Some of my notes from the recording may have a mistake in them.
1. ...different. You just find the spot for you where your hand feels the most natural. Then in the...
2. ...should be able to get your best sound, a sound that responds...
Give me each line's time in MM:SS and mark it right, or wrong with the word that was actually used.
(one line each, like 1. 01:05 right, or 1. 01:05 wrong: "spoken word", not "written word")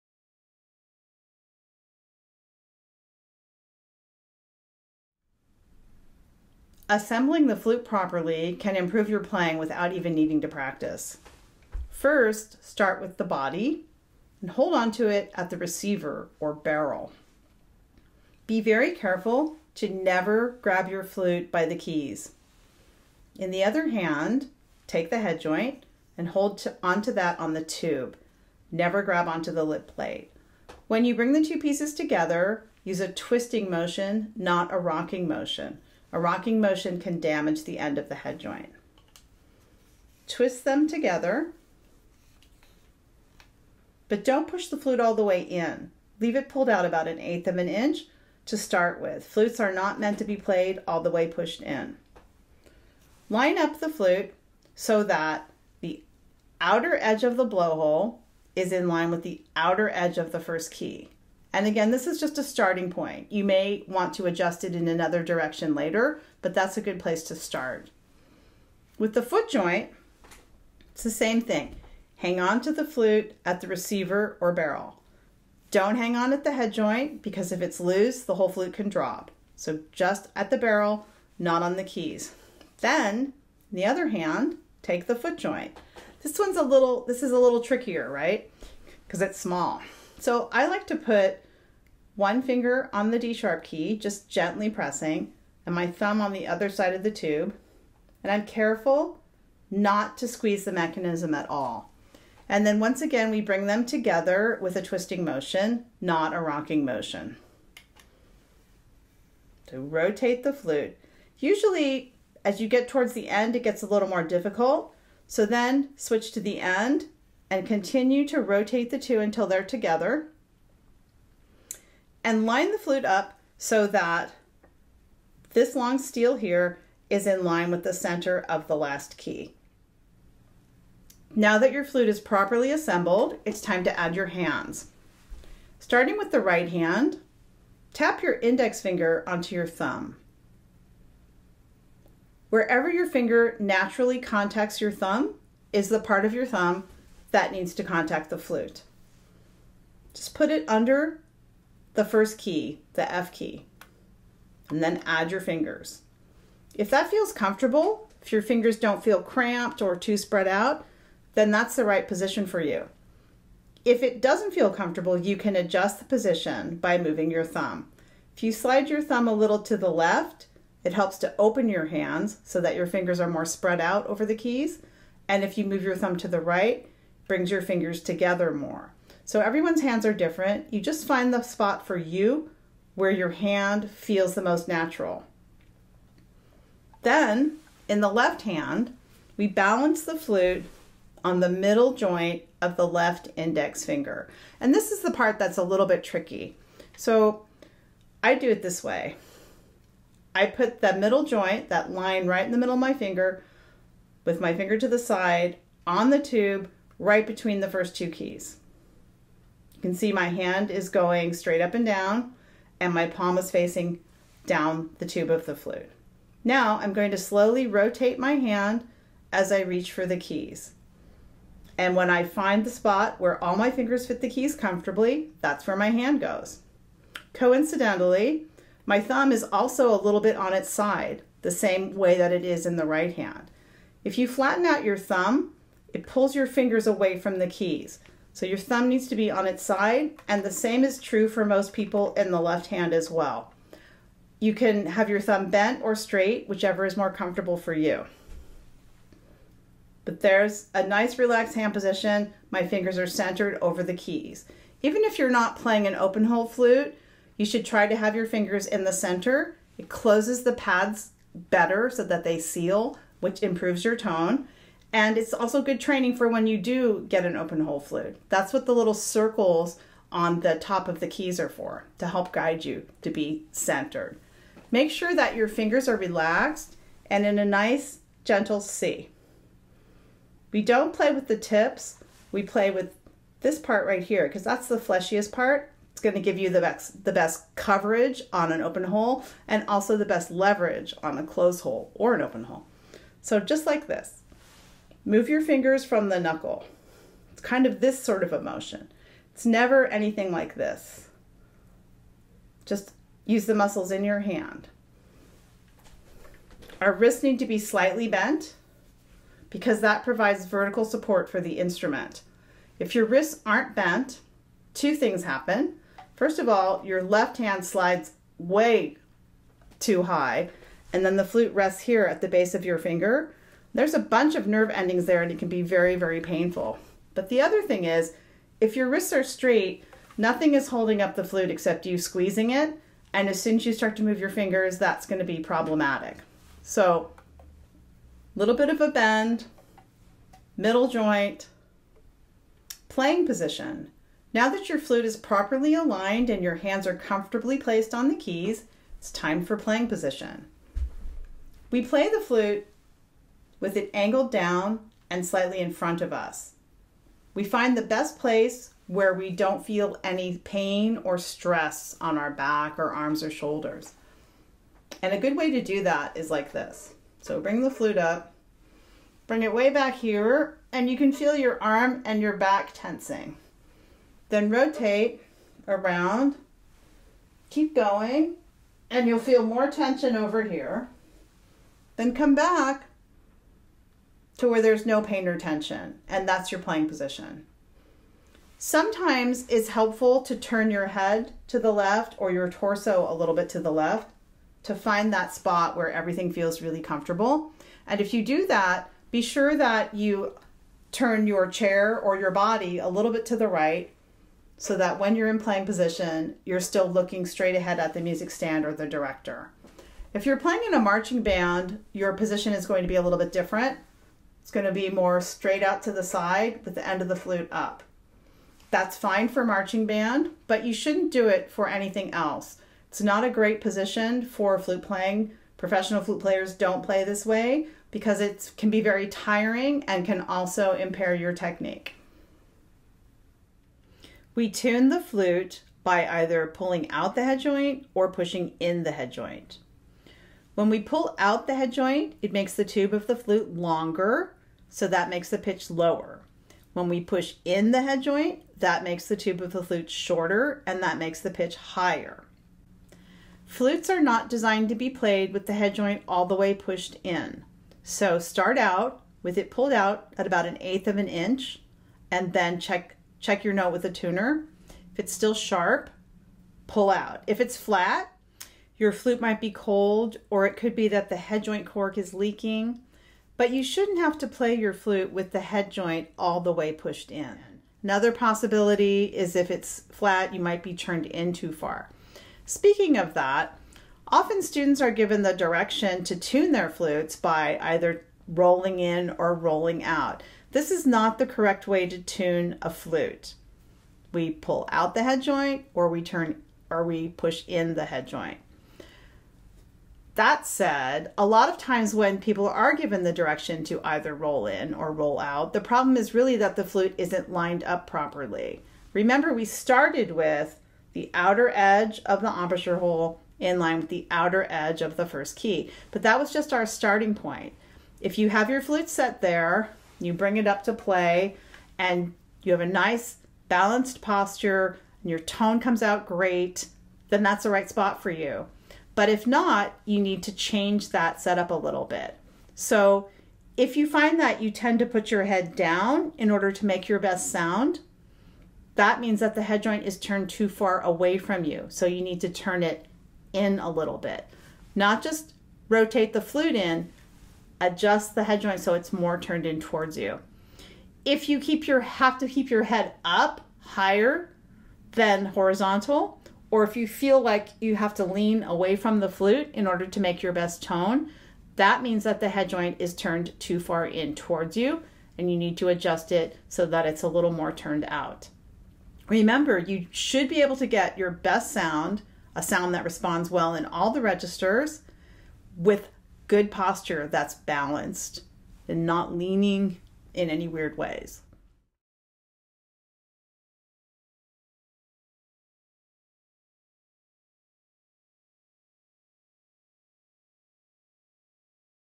1. 03:00 right
2. 09:29 right.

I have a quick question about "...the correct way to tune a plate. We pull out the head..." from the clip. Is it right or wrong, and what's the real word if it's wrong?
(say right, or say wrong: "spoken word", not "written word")
wrong: "flute", not "plate".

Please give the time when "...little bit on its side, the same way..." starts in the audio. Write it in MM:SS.
03:50.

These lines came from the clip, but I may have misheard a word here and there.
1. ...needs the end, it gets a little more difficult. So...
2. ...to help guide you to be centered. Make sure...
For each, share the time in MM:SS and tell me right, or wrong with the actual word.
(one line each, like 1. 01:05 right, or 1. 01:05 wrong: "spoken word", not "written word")
1. 01:52 wrong: "towards", not "needs"
2. 04:31 right.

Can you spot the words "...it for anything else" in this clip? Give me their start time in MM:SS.
07:01.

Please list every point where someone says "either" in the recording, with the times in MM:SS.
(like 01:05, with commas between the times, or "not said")
07:16, 08:07, 08:23.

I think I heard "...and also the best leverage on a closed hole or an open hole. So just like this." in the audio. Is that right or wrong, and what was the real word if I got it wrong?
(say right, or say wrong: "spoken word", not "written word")
right.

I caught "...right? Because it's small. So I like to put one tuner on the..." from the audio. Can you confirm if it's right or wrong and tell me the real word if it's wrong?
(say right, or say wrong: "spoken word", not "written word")
wrong: "finger", not "tuner".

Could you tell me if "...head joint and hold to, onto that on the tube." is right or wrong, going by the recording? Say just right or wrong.
right.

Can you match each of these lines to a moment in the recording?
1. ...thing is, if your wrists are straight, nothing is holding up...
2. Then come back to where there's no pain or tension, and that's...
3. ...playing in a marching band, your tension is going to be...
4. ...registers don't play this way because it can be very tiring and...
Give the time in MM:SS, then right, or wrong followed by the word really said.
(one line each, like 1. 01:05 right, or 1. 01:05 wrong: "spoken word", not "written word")
1. 05:27 right
2. 06:21 right
3. 06:50 wrong: "position", not "tension"
4. 07:06 wrong: "players", not "registers".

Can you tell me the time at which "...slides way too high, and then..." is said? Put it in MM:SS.
05:17.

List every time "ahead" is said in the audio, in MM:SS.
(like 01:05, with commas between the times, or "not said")
06:47.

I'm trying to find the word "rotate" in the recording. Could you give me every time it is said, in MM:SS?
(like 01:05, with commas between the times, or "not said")
01:49, 01:58, 03:37, 06:14, 09:05.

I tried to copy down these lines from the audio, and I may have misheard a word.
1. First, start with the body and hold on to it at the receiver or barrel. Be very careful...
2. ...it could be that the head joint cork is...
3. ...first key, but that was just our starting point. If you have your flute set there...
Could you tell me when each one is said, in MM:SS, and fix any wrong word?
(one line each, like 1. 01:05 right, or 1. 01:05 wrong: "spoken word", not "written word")
1. 00:11 right
2. 07:50 right
3. 08:35 right.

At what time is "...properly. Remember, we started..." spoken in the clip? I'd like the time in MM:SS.
08:27.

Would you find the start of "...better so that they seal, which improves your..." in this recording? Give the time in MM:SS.
04:21.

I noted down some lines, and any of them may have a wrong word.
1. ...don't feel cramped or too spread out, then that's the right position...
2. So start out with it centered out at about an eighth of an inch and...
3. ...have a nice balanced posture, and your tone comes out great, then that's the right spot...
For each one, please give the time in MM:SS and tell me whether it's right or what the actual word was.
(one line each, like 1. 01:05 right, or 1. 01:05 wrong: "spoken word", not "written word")
1. 02:38 right
2. 07:37 wrong: "pulled", not "centered"
3. 08:42 right.